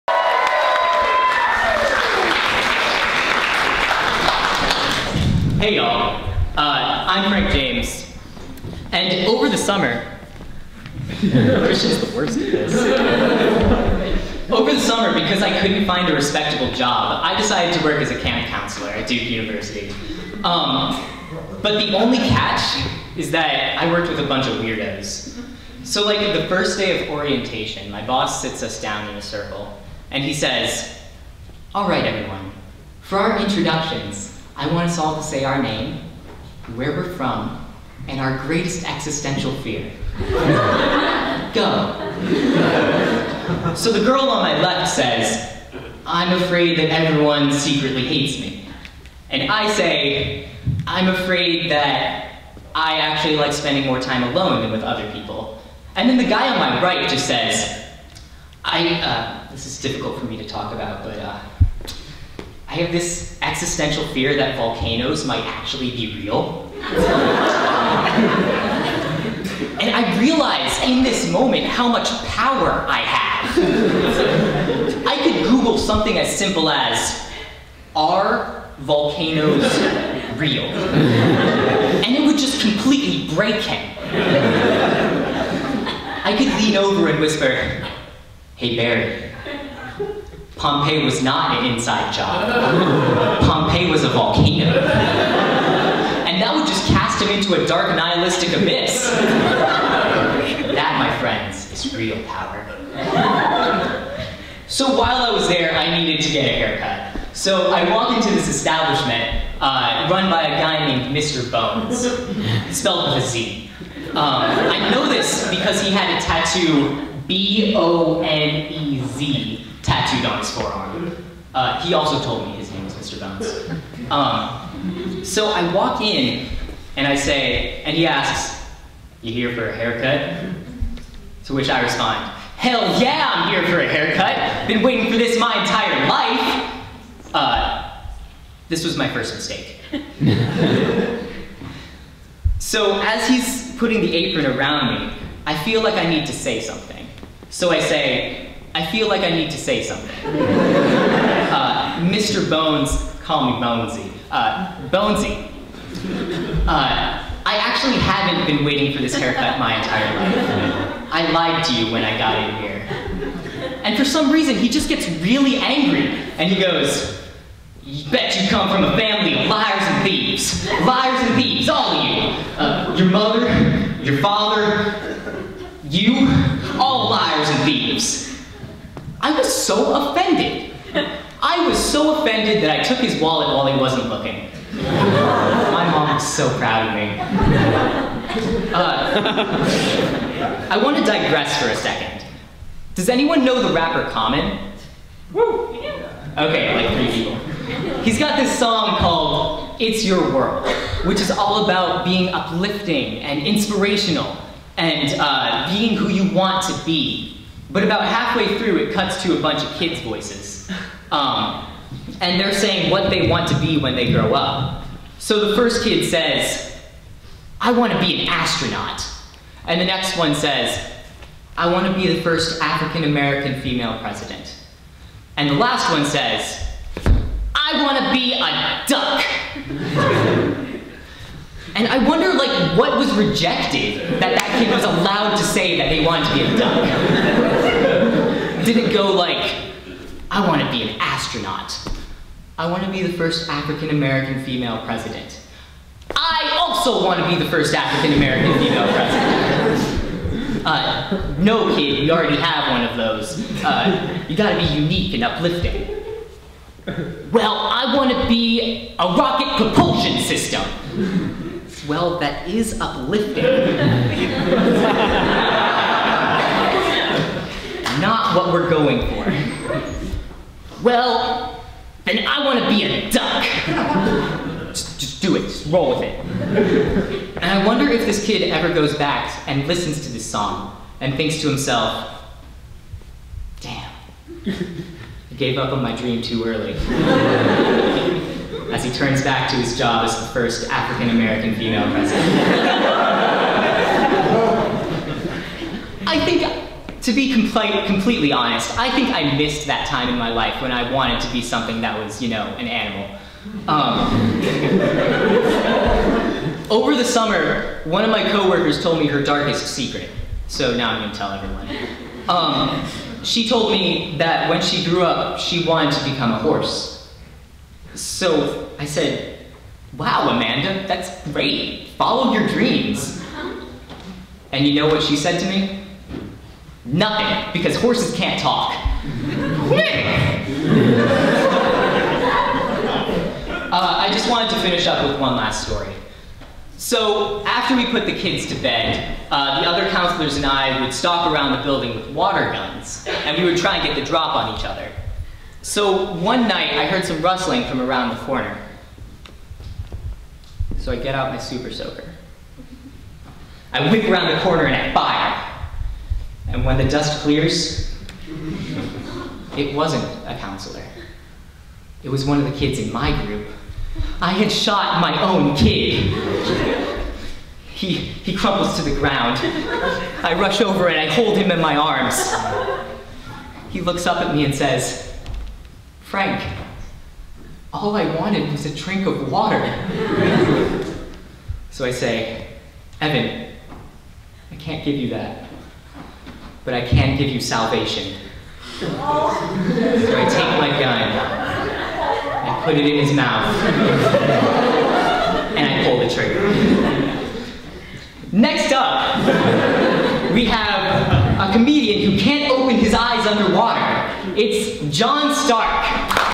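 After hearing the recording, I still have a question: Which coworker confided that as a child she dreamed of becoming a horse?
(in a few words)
Amanda.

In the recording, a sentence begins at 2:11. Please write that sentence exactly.
To which I respond, Hell yeah, I'm here for a haircut.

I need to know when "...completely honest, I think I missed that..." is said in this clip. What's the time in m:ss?
4:57.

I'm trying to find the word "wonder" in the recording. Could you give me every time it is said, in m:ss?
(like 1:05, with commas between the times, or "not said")
3:52, 4:37.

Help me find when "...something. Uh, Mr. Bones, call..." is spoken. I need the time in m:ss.
2:29.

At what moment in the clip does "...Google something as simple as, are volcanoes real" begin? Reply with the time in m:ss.
1:15.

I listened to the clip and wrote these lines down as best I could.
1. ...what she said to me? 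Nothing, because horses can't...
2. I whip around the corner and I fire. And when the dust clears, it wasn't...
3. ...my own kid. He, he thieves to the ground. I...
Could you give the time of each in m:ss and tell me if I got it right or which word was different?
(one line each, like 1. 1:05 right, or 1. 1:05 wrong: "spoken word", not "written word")
1. 5:24 right
2. 5:53 right
3. 6:05 wrong: "crumbles", not "thieves".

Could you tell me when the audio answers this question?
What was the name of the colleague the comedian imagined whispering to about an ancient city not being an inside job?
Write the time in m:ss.
1:28.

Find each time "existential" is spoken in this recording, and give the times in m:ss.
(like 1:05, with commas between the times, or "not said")
0:38, 1:03.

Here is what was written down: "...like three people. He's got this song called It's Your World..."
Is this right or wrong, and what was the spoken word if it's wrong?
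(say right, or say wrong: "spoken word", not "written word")
right.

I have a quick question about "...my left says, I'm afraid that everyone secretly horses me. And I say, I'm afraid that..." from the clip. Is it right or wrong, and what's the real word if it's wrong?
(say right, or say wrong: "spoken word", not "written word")
wrong: "hates", not "horses".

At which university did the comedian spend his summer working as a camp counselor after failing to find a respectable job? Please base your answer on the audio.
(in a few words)
Duke University.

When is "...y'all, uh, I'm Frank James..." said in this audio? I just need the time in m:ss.
0:05.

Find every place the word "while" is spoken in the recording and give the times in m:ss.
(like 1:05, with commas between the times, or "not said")
1:44, 3:03.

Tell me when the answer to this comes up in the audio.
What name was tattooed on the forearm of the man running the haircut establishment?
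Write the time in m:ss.
1:57.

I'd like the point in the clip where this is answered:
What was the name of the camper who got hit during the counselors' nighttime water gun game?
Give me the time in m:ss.
6:22.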